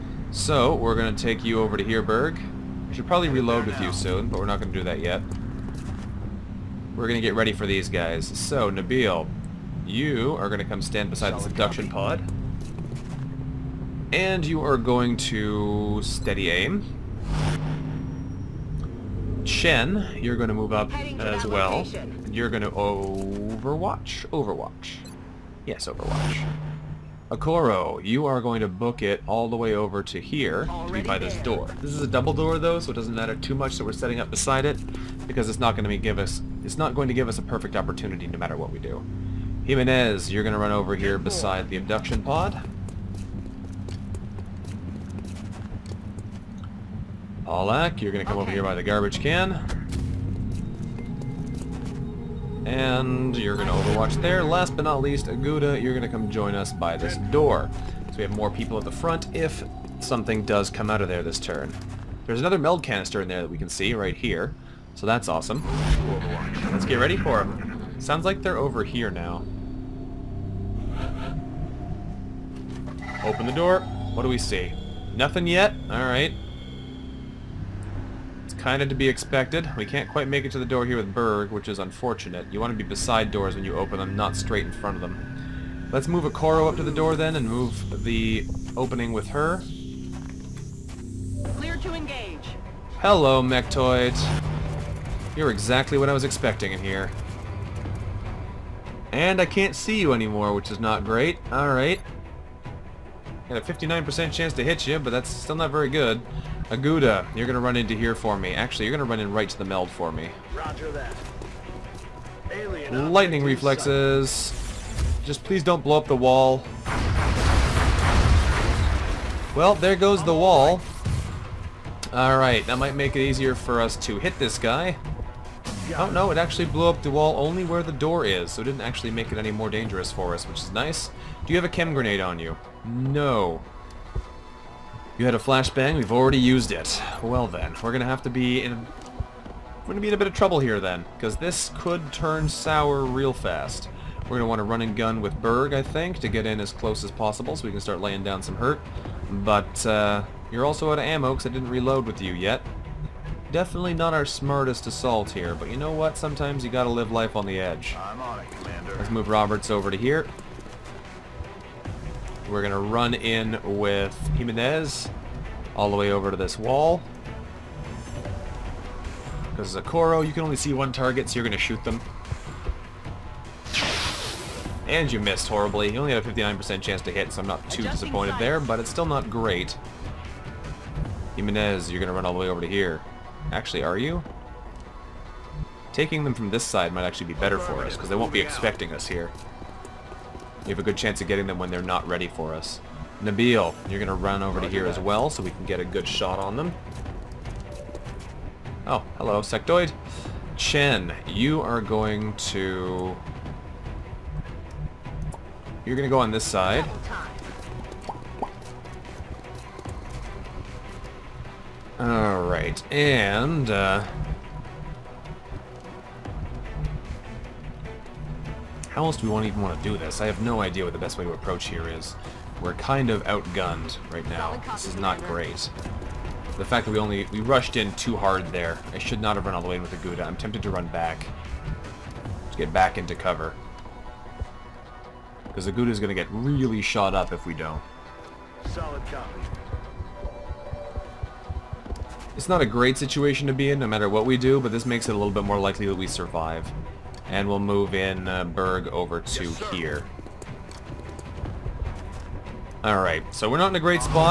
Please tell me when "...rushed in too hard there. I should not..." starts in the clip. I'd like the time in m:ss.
3:47.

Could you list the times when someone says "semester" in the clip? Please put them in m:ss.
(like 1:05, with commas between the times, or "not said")
not said.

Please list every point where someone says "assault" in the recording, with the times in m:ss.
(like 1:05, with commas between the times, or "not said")
2:34.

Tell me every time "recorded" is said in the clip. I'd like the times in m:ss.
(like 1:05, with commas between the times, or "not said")
not said.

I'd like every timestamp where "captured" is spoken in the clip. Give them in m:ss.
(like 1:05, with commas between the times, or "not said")
not said.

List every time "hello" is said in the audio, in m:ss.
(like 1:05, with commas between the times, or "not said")
1:32, 3:19.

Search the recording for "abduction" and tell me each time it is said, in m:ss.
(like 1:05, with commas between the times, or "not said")
0:11, 0:41.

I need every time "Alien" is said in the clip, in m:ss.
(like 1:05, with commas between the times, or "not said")
1:52.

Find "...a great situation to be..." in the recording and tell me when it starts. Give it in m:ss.
4:02.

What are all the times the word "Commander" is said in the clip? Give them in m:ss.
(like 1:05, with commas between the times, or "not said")
2:38.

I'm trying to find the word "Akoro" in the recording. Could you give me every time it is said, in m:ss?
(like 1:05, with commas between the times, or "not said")
0:27, 2:49.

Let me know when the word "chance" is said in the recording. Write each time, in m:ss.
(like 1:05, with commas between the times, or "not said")
1:44, 2:56, 3:10.